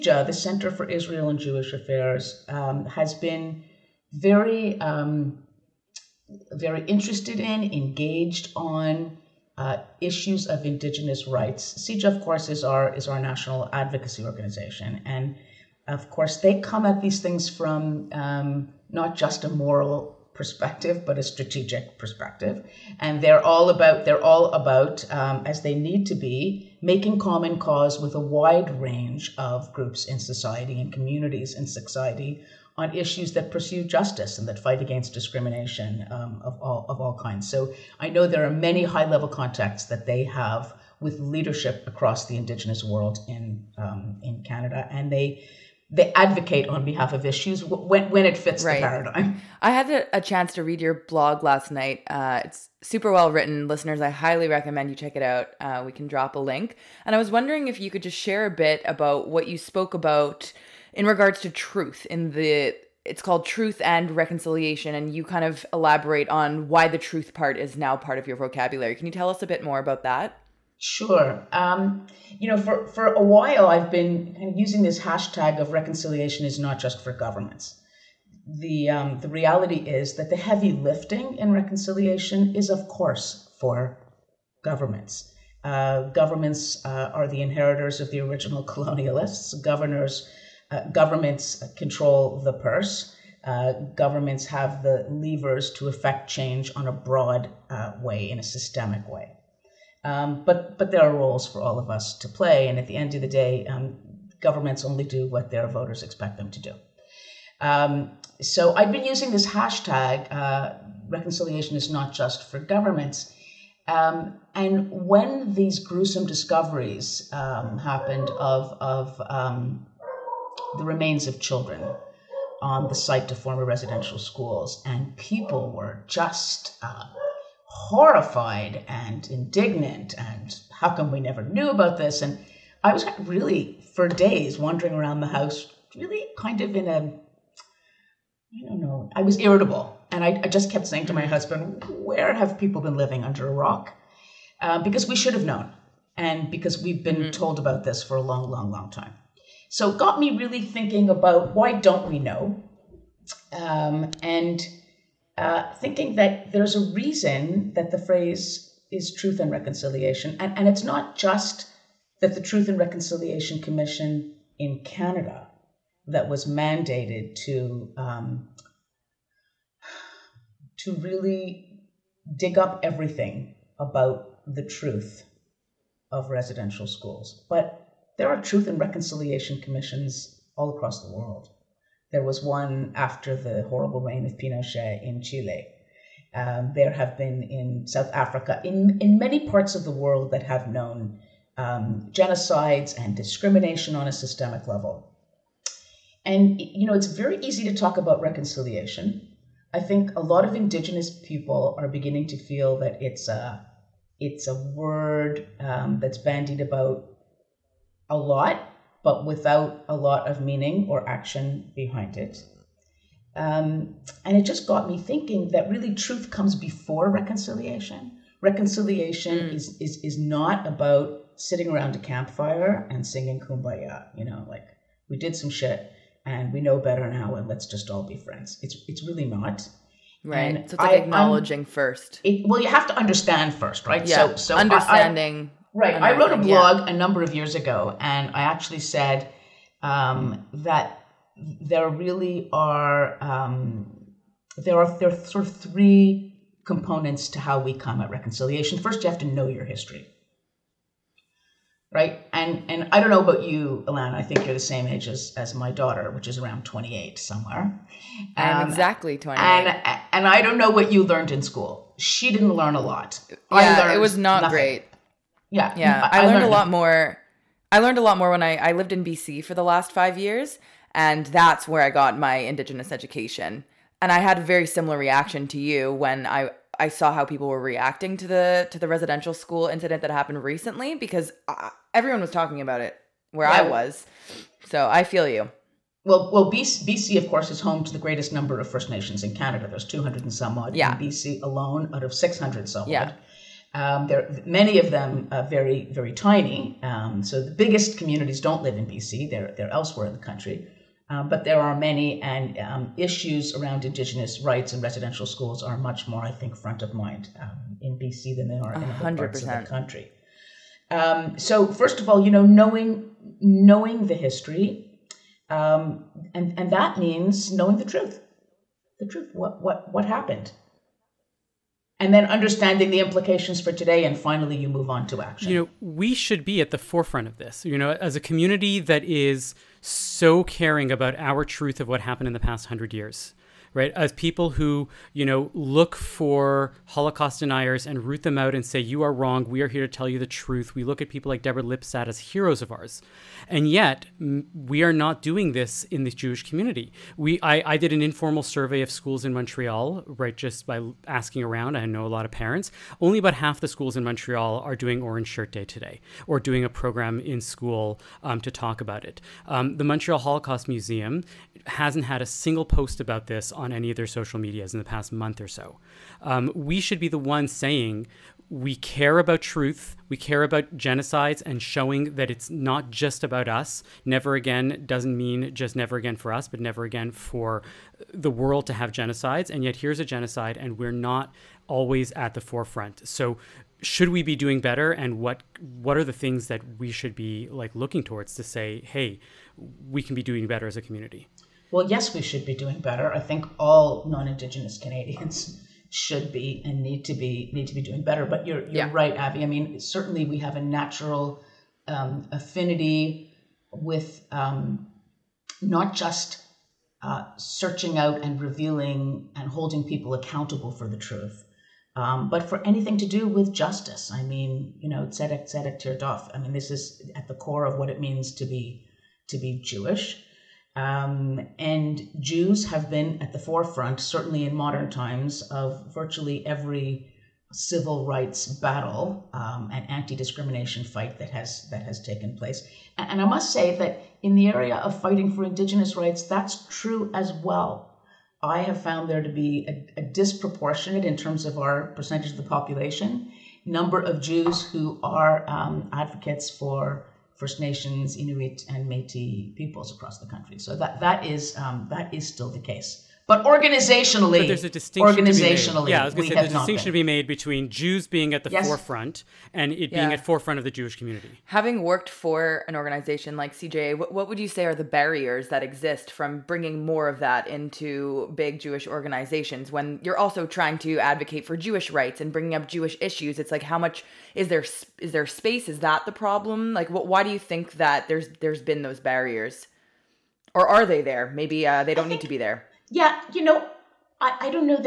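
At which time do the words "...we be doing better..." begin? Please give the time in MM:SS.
06:24.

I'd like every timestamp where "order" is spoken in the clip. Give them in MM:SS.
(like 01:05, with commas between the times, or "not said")
not said.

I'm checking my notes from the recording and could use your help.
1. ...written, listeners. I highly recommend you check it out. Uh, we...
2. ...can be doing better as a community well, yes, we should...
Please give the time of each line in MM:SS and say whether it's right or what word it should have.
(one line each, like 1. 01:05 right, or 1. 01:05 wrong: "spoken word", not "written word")
1. 00:53 right
2. 06:30 right.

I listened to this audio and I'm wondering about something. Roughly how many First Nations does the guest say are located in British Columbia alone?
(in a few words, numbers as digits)
200 and some.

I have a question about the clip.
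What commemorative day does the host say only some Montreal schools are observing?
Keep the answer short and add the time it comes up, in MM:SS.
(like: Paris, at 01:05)
Orange Shirt Day, at 05:55.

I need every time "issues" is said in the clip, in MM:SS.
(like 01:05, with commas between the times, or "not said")
00:10, 00:32, 00:47, 05:02, 07:53.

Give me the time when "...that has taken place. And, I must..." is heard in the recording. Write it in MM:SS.
07:11.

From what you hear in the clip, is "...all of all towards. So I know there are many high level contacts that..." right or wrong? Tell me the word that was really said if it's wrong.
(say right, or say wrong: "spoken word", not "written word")
wrong: "kinds", not "towards".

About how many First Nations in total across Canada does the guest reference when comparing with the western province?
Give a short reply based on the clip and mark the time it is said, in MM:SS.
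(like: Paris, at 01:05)
600 some, at 04:52.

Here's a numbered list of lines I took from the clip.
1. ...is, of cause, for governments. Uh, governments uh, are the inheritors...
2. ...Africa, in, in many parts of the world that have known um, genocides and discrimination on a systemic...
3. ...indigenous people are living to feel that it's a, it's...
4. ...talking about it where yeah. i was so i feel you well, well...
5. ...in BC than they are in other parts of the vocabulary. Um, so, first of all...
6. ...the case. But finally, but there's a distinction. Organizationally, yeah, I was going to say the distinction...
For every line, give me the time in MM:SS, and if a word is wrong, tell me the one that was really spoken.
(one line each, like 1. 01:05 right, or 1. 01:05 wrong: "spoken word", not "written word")
1. 01:22 wrong: "course", not "cause"
2. 03:08 right
3. 03:20 wrong: "beginning", not "living"
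4. 04:42 right
5. 05:07 wrong: "country", not "vocabulary"
6. 07:32 wrong: "organizationally", not "finally".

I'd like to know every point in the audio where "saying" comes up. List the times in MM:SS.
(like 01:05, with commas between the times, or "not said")
02:20, 06:07.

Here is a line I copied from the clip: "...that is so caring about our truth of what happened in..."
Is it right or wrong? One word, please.
right.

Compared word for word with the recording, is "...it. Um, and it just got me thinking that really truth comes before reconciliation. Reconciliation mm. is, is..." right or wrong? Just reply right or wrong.
right.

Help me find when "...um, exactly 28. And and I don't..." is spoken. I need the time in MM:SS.
04:18.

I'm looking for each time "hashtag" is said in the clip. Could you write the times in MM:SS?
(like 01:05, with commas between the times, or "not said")
01:14, 01:49.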